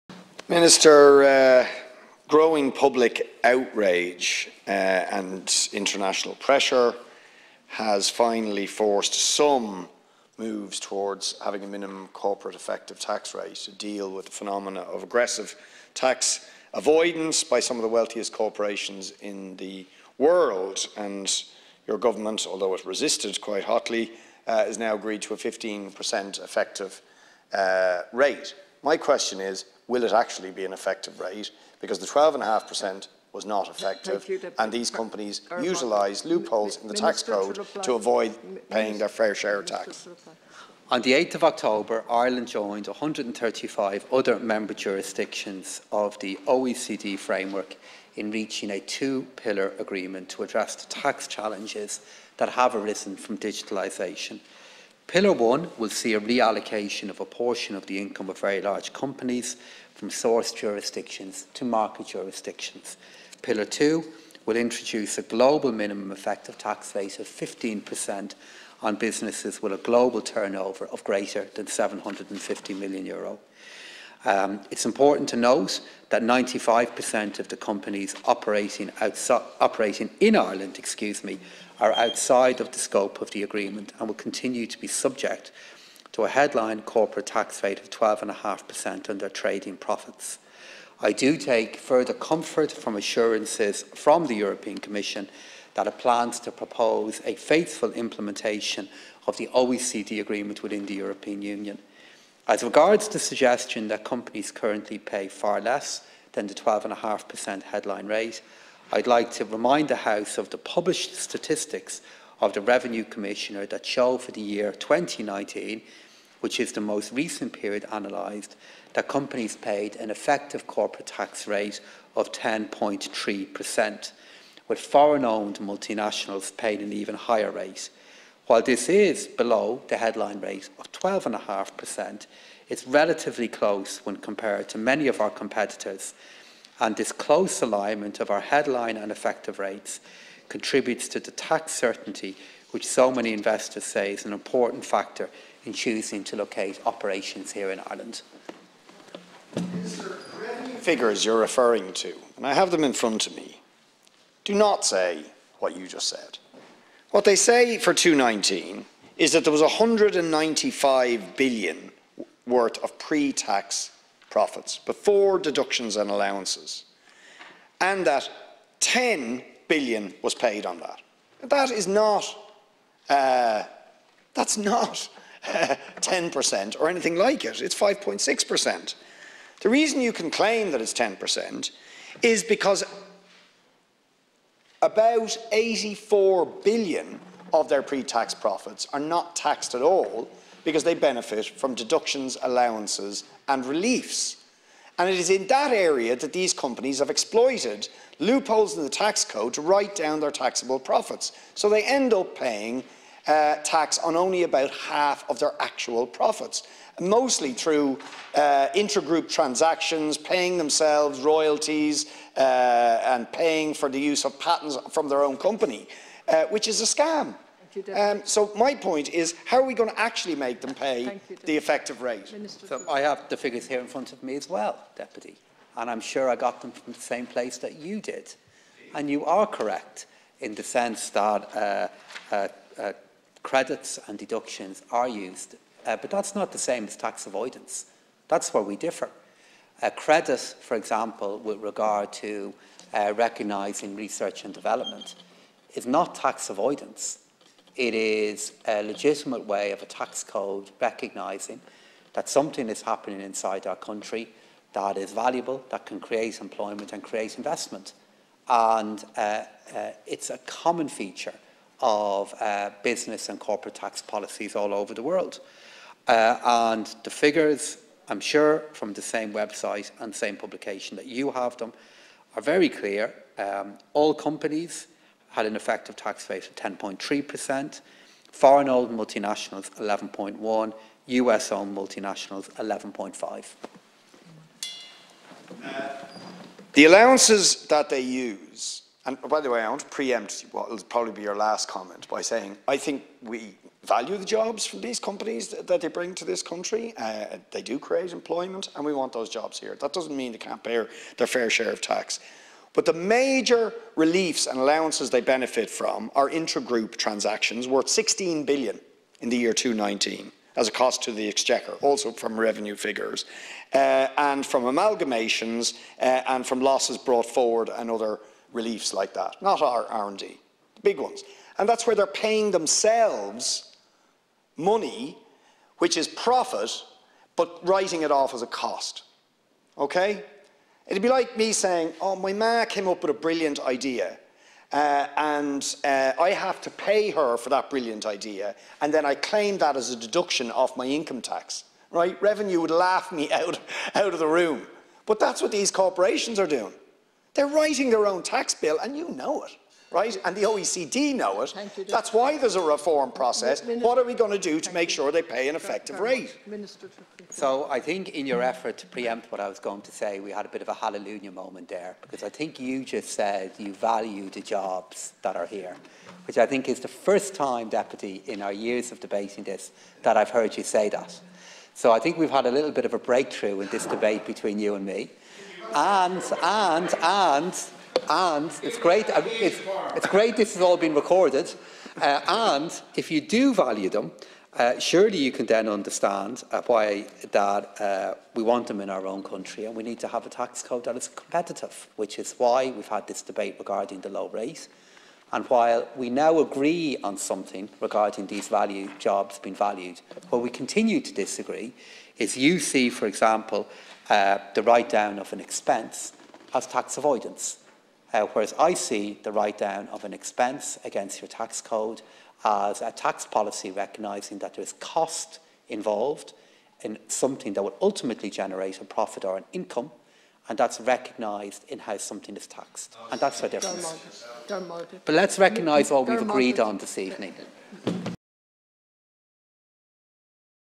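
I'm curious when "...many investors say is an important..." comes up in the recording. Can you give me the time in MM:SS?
02:23.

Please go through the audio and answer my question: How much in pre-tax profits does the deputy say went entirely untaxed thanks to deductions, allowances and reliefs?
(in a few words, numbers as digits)
84 billion.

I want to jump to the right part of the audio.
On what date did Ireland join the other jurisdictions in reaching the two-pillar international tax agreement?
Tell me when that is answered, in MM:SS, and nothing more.
00:41.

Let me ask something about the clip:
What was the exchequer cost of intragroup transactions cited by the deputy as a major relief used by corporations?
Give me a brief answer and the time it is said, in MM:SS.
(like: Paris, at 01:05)
16 billion, at 05:07.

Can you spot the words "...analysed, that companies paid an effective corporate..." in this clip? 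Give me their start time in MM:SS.
01:57.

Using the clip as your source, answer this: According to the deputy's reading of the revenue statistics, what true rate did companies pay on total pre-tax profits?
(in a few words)
5.6%.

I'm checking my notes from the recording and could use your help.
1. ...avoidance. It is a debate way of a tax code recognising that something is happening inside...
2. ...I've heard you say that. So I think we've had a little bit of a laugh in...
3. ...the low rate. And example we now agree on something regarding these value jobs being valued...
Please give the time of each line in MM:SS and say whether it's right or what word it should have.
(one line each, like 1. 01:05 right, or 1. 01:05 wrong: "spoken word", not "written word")
1. 04:06 wrong: "legitimate", not "debate"
2. 06:10 wrong: "breakthrough", not "laugh"
3. 06:34 wrong: "while", not "example".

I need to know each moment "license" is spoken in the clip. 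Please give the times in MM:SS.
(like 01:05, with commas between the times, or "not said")
not said.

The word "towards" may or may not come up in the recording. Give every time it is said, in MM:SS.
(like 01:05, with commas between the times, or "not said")
00:10.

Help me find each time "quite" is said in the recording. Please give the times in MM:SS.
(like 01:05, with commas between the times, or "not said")
00:23.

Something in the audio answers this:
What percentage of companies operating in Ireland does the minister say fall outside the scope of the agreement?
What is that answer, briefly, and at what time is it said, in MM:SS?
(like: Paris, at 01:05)
95%, at 01:16.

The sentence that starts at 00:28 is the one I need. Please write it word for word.
My question is, will it actually be an effective rate?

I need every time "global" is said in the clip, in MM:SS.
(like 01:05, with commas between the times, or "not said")
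01:05, 01:09.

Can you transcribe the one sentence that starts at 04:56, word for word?
Uh, they do create employment, and we want those jobs here.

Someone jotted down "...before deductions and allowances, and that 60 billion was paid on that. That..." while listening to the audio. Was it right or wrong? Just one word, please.
wrong.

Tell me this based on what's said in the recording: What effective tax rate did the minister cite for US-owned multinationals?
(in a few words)
11.5%.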